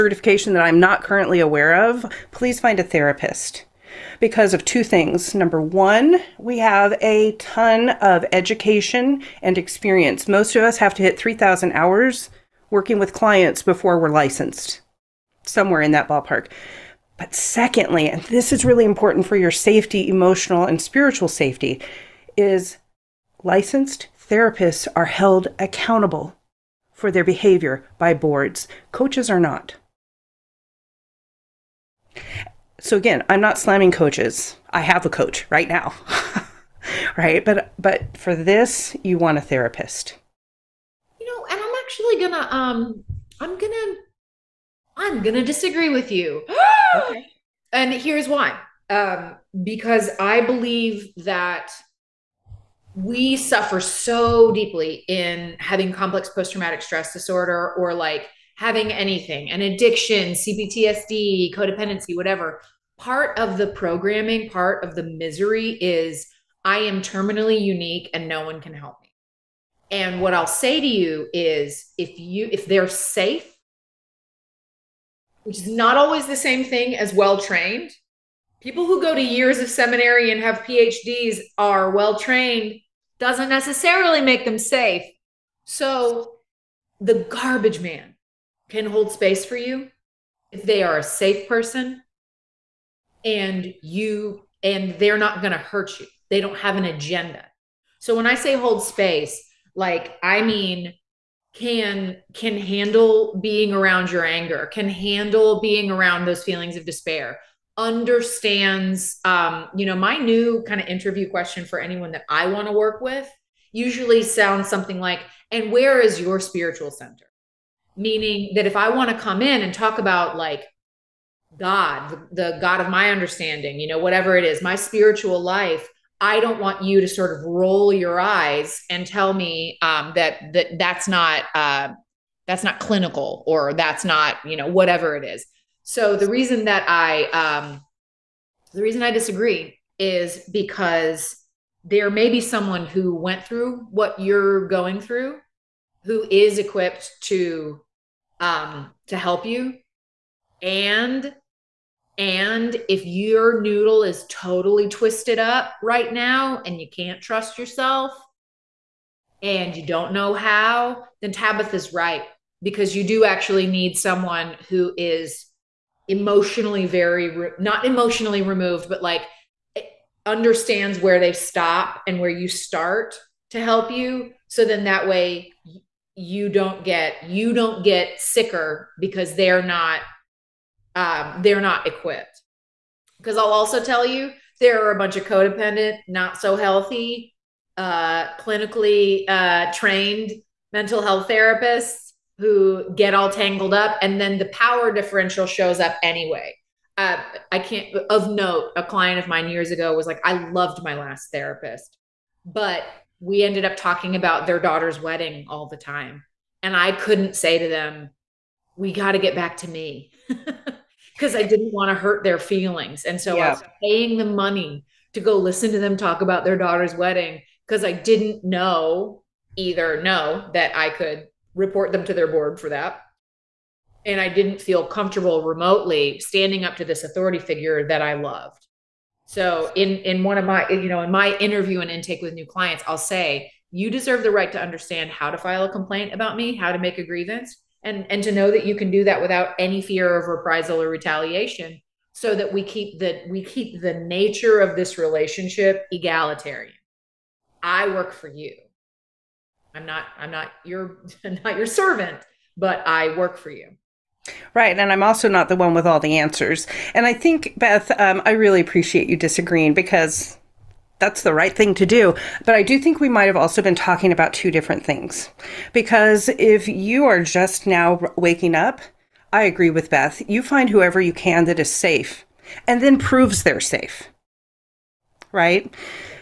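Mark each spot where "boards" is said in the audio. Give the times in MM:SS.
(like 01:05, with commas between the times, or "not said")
00:28, 03:42.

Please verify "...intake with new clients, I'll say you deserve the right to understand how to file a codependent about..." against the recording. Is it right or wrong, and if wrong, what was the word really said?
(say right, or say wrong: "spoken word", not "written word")
wrong: "complaint", not "codependent".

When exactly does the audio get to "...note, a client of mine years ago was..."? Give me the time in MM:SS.
03:18.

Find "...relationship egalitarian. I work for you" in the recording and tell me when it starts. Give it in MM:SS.
04:04.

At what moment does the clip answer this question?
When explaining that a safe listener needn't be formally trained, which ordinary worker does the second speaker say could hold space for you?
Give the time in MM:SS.
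01:26.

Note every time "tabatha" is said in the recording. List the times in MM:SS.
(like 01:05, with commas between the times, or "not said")
02:41.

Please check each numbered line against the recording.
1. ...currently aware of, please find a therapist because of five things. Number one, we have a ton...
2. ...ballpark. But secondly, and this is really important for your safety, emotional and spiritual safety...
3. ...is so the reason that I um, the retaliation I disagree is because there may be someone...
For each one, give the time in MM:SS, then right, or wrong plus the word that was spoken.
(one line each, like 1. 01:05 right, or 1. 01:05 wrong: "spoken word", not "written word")
1. 00:01 wrong: "two", not "five"
2. 00:16 right
3. 02:15 wrong: "reason", not "retaliation".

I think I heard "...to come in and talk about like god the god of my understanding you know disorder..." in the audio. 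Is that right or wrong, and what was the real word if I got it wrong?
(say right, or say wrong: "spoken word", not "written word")
wrong: "whatever", not "disorder".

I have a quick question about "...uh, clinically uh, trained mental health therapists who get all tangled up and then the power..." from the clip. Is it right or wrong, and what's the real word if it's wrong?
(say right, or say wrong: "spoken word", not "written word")
right.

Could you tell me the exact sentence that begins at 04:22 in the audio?
But I do think we might have also been talking about two different things.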